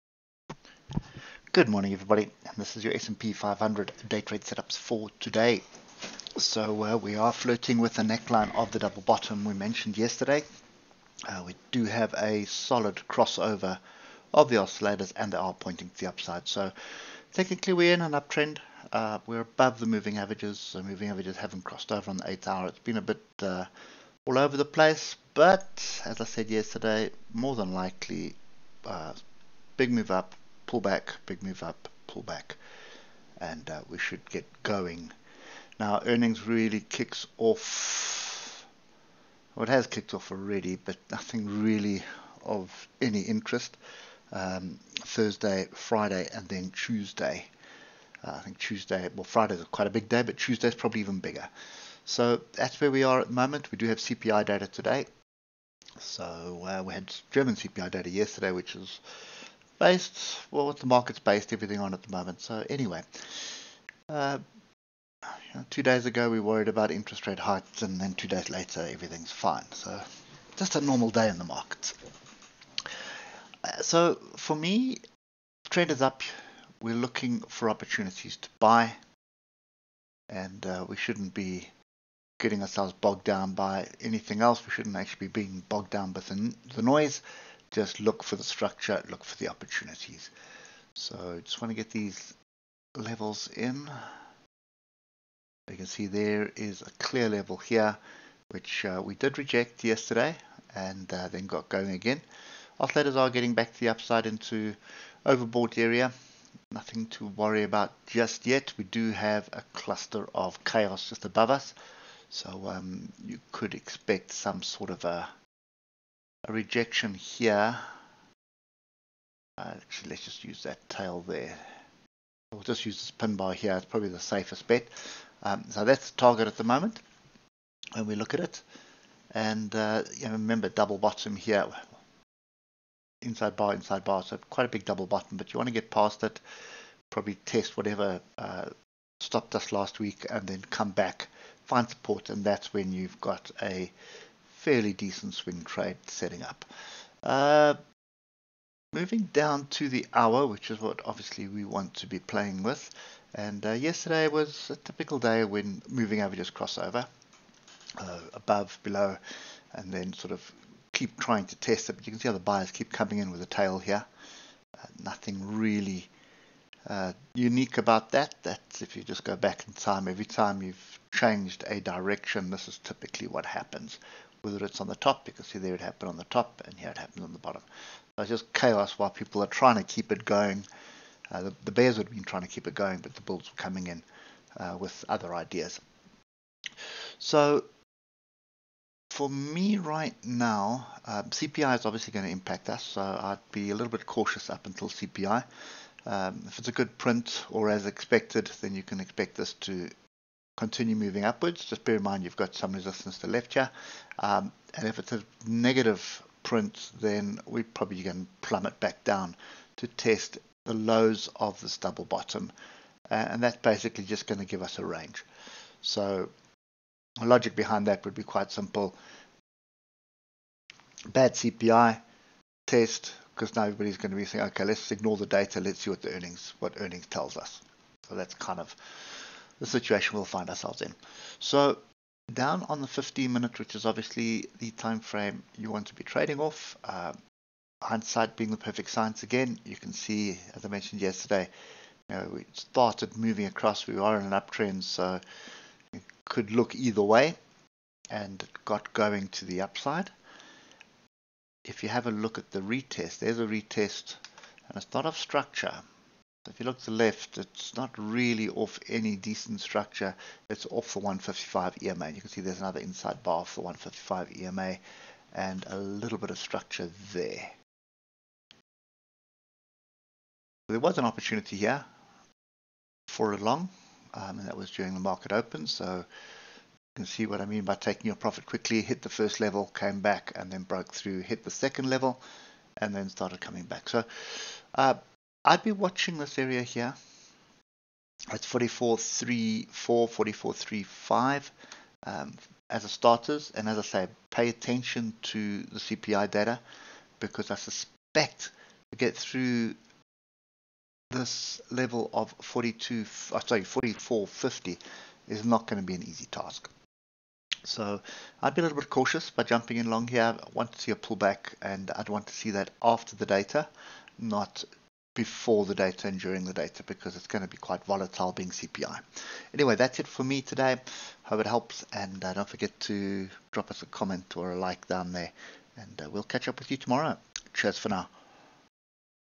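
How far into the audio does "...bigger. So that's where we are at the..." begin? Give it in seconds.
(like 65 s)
51 s.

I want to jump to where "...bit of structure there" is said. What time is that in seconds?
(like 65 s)
266 s.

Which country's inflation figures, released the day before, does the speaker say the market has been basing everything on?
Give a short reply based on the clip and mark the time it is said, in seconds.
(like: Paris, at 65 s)
German, at 57 s.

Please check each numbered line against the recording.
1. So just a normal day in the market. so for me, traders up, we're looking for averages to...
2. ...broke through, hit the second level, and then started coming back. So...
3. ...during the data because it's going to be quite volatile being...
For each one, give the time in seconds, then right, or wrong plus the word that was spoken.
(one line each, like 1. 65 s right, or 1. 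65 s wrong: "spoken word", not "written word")
1. 69 s wrong: "opportunities", not "averages"
2. 280 s right
3. 316 s right.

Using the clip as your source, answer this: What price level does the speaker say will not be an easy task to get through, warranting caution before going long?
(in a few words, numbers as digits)
44.50.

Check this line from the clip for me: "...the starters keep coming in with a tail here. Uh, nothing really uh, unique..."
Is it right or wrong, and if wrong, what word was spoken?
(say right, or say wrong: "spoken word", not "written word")
wrong: "buyers", not "starters".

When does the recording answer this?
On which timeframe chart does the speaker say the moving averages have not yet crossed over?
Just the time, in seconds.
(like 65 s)
22 s.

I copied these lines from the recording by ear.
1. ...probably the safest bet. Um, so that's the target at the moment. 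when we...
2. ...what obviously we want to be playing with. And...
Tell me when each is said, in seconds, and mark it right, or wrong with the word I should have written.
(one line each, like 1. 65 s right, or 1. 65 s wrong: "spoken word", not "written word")
1. 123 s right
2. 150 s right.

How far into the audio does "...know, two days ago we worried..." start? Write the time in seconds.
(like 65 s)
65 s.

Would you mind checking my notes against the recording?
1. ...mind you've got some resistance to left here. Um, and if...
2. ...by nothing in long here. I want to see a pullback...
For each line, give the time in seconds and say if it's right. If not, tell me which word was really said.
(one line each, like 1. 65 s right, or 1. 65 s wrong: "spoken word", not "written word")
1. 202 s right
2. 309 s wrong: "jumping", not "nothing".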